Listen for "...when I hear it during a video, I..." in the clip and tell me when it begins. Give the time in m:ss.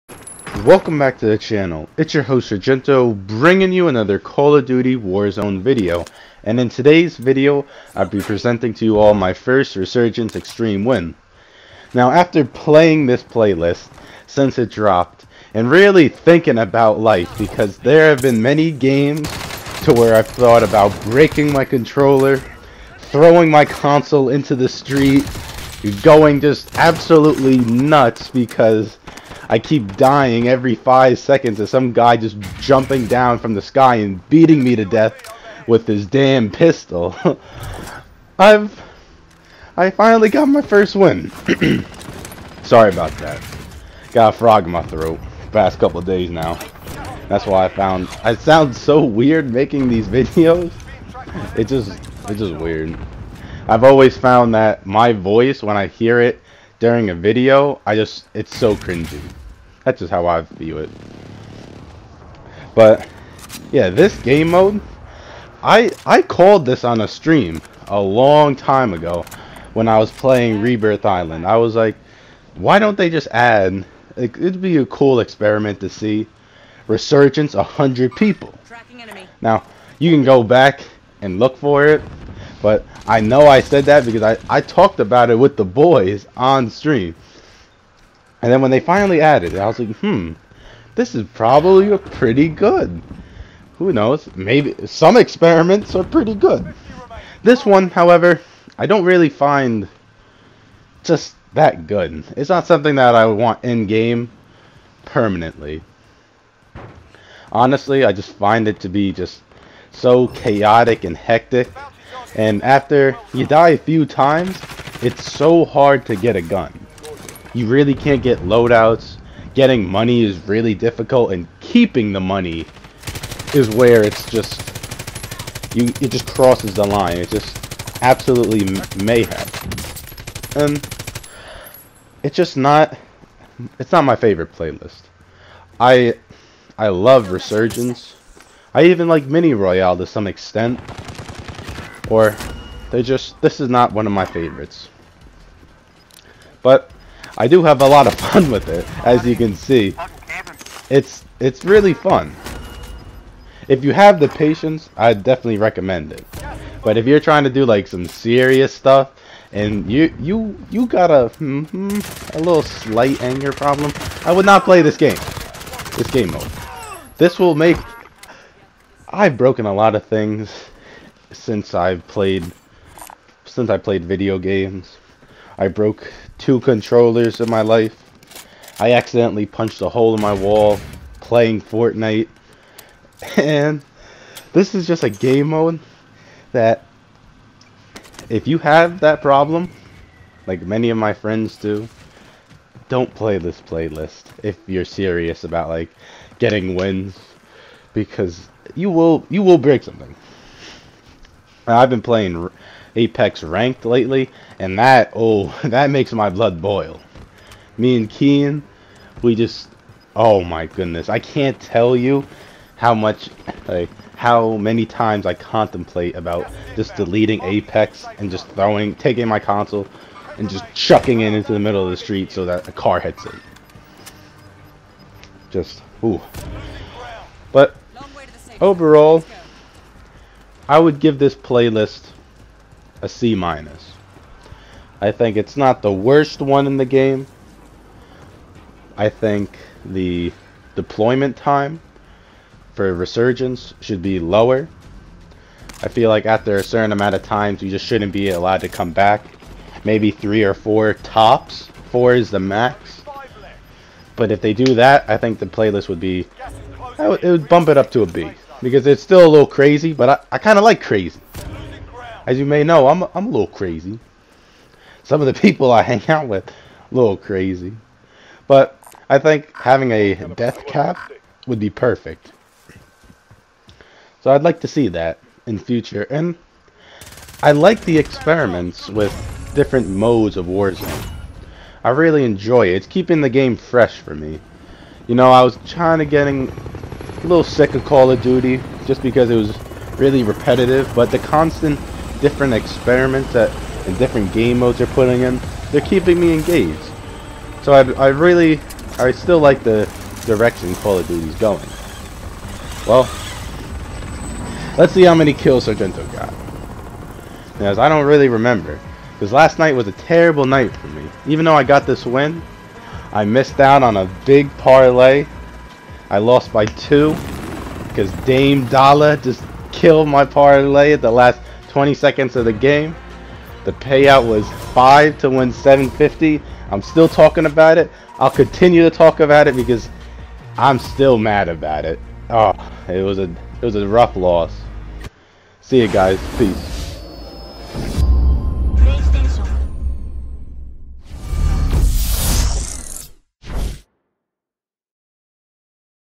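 0:55.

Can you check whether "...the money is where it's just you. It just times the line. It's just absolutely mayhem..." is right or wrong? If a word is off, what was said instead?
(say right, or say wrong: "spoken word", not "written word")
wrong: "crosses", not "times".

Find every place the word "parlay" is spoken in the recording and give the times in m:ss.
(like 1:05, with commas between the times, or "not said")
5:14, 5:20.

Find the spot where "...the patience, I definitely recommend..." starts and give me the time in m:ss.
2:34.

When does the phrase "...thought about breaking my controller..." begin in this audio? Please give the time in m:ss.
0:20.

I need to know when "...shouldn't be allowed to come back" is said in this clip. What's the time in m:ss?
4:07.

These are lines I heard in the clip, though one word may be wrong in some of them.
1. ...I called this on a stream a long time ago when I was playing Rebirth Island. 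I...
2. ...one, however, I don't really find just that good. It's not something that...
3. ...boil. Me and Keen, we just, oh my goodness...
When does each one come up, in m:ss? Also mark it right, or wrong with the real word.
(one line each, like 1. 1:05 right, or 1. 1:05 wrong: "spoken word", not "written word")
1. 1:06 right
2. 1:37 right
3. 3:26 right.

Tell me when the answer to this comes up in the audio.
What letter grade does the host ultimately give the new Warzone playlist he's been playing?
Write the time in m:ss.
3:53.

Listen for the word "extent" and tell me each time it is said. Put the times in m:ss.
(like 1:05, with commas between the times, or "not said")
2:20.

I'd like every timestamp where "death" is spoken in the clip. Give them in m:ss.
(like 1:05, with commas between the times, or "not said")
0:34, 4:30.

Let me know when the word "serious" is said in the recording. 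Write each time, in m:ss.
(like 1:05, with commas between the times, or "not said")
2:38, 3:14.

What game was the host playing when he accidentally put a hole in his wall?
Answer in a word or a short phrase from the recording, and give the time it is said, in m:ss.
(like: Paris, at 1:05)
Fortnite, at 3:01.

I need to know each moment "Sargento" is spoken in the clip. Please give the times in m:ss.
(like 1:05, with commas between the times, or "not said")
0:02, 5:05.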